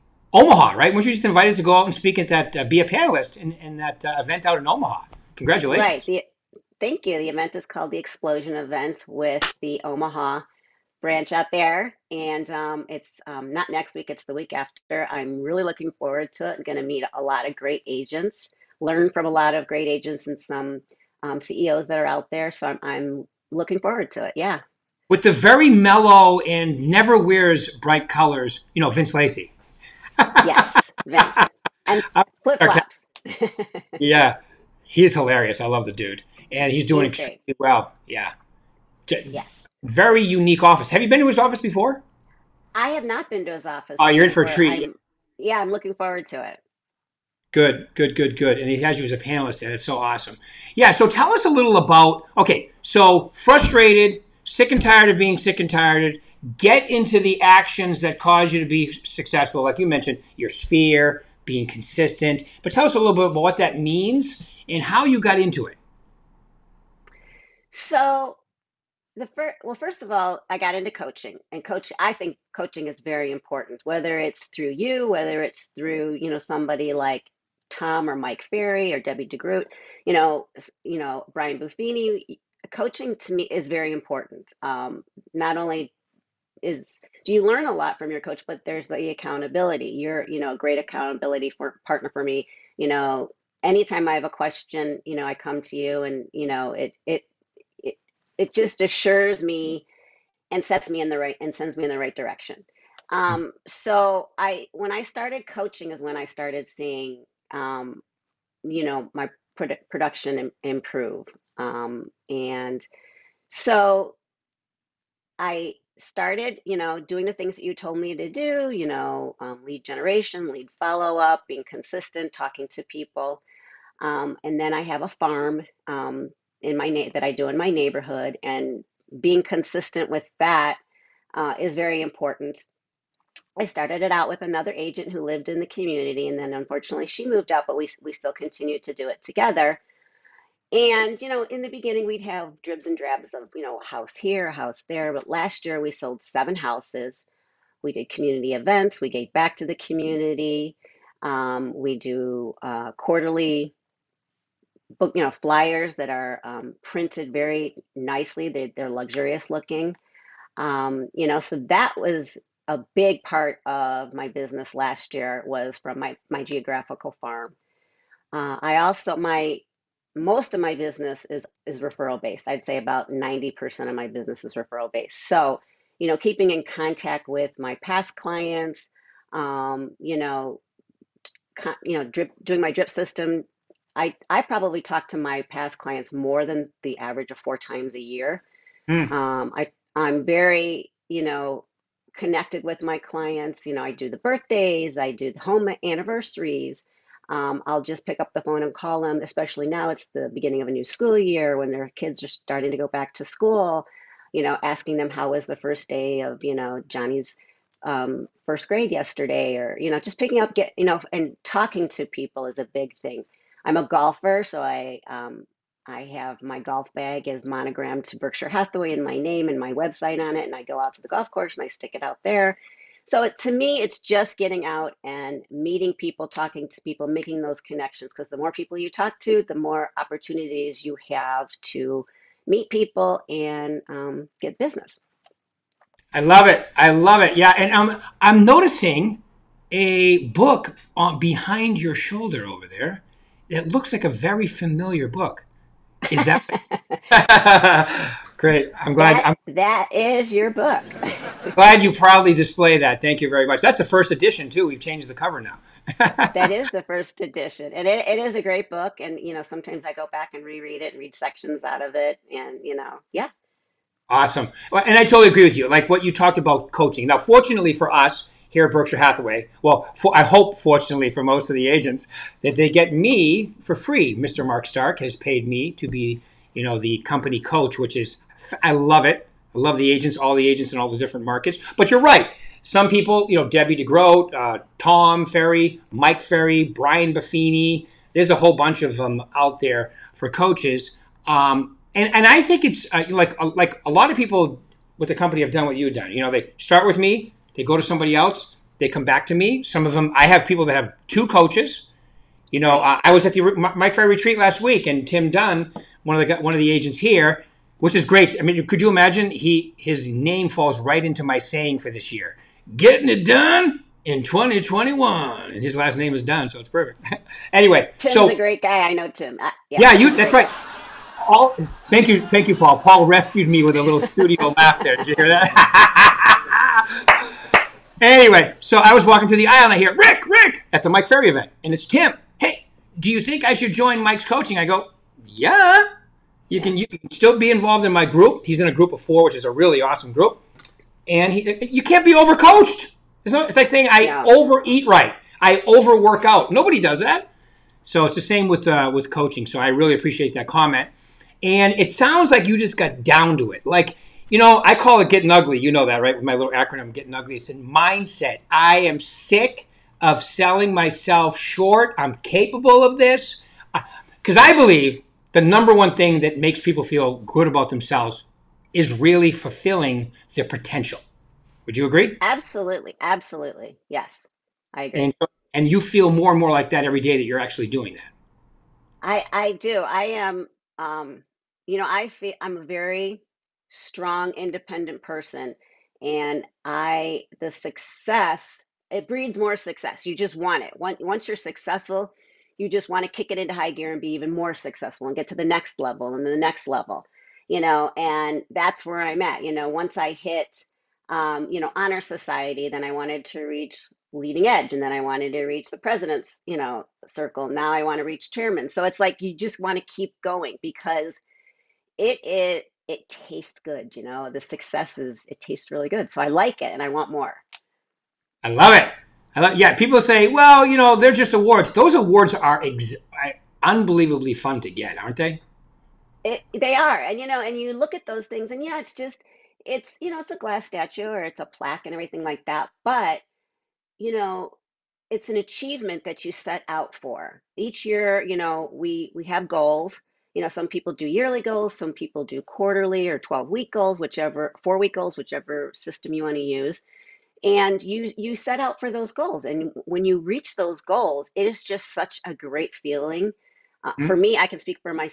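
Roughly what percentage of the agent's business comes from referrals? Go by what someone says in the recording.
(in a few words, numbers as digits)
90%.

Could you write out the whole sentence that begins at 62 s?
But tell us a little bit about what that means and how you got into it.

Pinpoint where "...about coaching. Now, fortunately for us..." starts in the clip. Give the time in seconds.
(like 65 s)
266 s.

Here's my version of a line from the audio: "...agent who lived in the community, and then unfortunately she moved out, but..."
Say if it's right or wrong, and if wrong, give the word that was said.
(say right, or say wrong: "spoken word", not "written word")
right.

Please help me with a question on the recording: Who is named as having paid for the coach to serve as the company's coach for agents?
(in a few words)
Mark Stark.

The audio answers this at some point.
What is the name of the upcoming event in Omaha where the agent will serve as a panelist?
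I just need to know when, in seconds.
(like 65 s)
7 s.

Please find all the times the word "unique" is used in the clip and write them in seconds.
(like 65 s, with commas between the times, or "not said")
40 s.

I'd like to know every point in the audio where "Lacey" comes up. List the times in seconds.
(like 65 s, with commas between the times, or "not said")
29 s.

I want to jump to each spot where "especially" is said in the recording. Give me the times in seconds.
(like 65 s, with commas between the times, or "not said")
199 s.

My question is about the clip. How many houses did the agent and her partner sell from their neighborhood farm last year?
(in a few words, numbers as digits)
7.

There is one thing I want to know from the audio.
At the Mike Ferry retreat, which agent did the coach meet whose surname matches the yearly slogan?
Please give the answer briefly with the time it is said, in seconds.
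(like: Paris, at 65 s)
Tim Dunn, at 305 s.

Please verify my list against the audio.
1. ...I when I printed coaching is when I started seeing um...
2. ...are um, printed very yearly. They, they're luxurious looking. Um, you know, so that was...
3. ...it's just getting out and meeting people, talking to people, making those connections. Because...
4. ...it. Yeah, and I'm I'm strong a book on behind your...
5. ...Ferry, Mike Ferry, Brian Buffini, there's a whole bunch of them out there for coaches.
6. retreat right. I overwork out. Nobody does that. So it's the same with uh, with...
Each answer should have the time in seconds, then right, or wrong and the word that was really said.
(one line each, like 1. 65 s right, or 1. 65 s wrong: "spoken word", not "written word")
1. 104 s wrong: "started", not "printed"
2. 156 s wrong: "nicely", not "yearly"
3. 223 s right
4. 237 s wrong: "noticing", not "strong"
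5. 285 s right
6. 344 s wrong: "overeat", not "retreat".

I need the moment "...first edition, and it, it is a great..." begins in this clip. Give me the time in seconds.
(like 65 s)
256 s.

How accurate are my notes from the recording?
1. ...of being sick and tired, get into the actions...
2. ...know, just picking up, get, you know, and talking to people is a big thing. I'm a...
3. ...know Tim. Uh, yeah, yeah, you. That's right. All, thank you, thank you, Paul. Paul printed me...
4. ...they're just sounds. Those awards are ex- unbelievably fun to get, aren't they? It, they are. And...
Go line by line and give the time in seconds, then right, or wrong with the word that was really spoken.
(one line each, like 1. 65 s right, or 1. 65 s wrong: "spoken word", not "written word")
1. 55 s right
2. 209 s right
3. 318 s wrong: "rescued", not "printed"
4. 420 s wrong: "awards", not "sounds".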